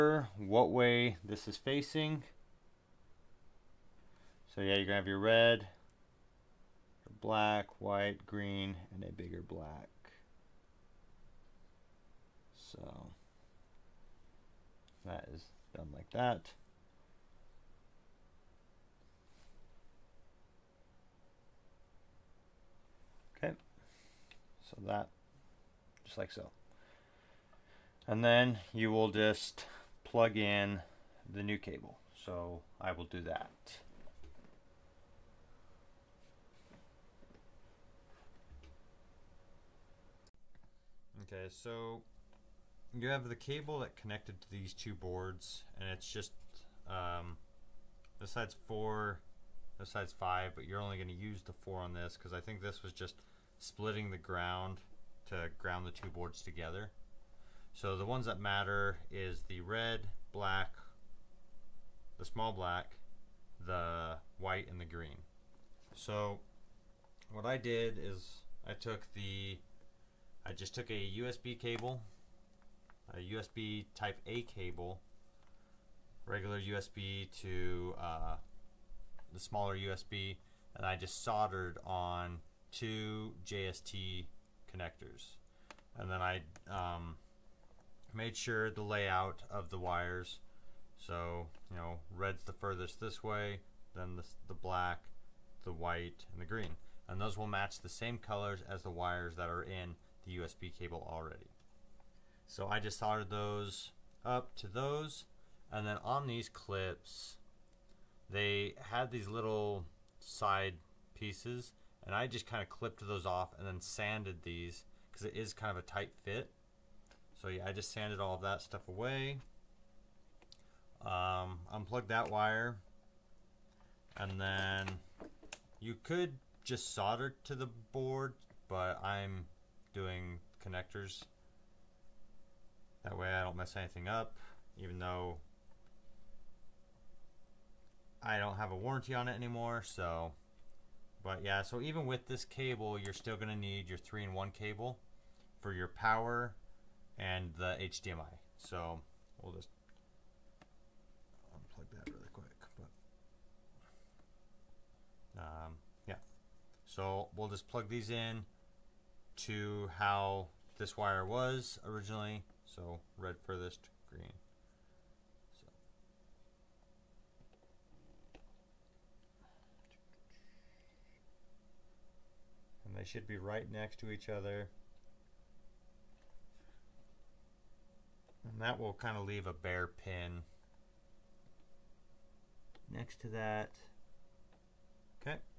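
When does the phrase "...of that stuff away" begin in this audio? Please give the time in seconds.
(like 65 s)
118 s.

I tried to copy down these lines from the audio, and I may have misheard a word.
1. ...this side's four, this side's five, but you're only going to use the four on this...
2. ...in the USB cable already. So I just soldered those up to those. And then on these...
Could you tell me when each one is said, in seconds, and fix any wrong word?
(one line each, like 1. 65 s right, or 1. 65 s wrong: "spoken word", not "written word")
1. 48 s right
2. 99 s right.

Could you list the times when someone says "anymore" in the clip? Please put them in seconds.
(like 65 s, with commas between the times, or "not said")
139 s.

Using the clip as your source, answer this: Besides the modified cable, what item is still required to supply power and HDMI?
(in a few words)
three in one cable.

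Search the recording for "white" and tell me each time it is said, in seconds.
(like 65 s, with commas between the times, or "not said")
7 s, 64 s, 95 s.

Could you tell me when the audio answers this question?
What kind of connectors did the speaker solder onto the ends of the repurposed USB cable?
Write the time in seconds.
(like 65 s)
83 s.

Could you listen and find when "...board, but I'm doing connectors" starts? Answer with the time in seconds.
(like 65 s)
127 s.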